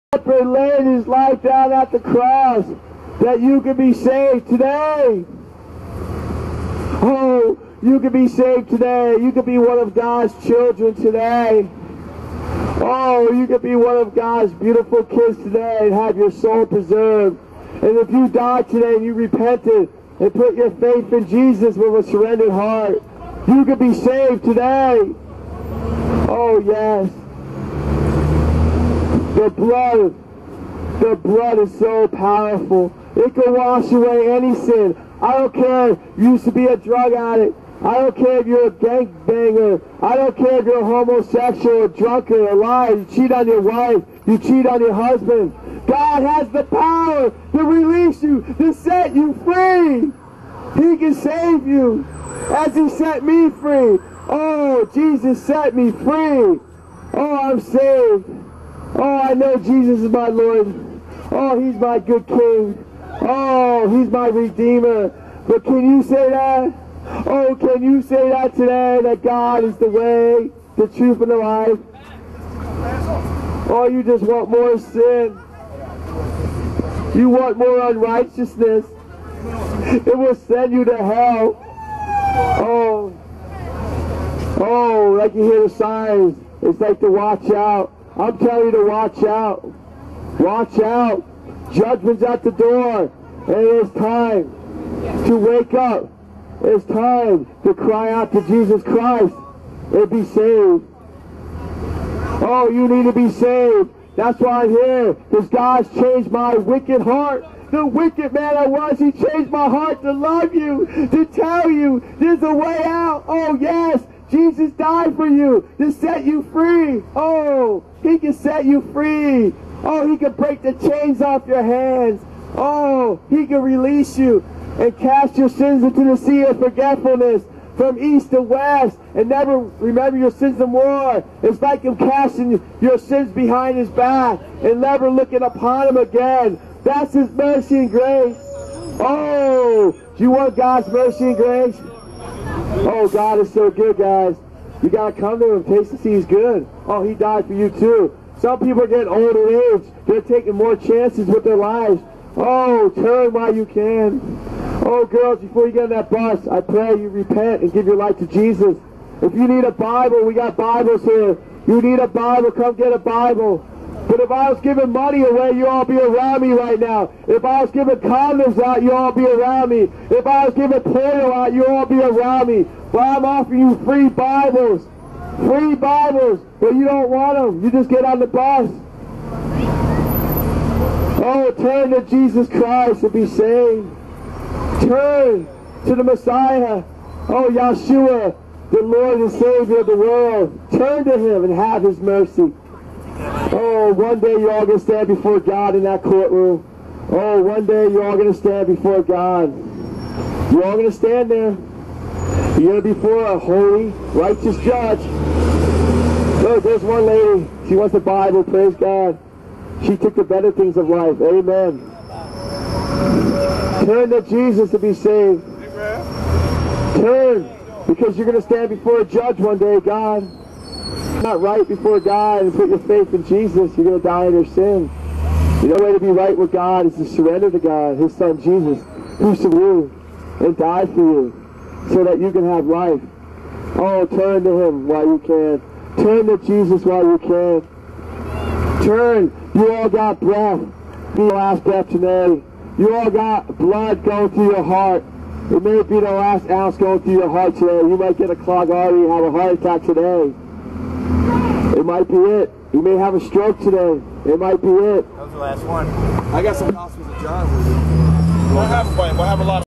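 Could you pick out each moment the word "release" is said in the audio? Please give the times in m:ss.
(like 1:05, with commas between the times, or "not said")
0:47, 2:03.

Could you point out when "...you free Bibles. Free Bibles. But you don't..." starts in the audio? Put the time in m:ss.
2:53.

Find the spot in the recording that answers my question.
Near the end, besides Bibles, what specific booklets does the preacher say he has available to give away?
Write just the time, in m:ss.
4:16.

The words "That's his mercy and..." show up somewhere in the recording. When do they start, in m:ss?
2:16.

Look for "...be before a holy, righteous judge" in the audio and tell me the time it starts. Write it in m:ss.
3:22.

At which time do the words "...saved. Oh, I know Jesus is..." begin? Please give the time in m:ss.
0:57.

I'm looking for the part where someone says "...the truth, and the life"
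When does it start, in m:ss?
1:10.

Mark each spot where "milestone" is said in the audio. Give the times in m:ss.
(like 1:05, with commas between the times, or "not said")
not said.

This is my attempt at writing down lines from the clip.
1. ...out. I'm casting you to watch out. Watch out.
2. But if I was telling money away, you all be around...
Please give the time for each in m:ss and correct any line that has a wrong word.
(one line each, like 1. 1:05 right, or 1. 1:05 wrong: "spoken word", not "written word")
1. 1:27 wrong: "telling", not "casting"
2. 2:44 wrong: "giving", not "telling".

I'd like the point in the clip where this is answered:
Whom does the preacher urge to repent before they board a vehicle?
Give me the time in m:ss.
2:35.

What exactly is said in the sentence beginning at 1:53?
Oh, yes, Jesus died for you to set you free.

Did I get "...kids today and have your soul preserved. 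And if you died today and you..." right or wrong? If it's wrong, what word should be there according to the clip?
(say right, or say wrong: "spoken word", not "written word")
right.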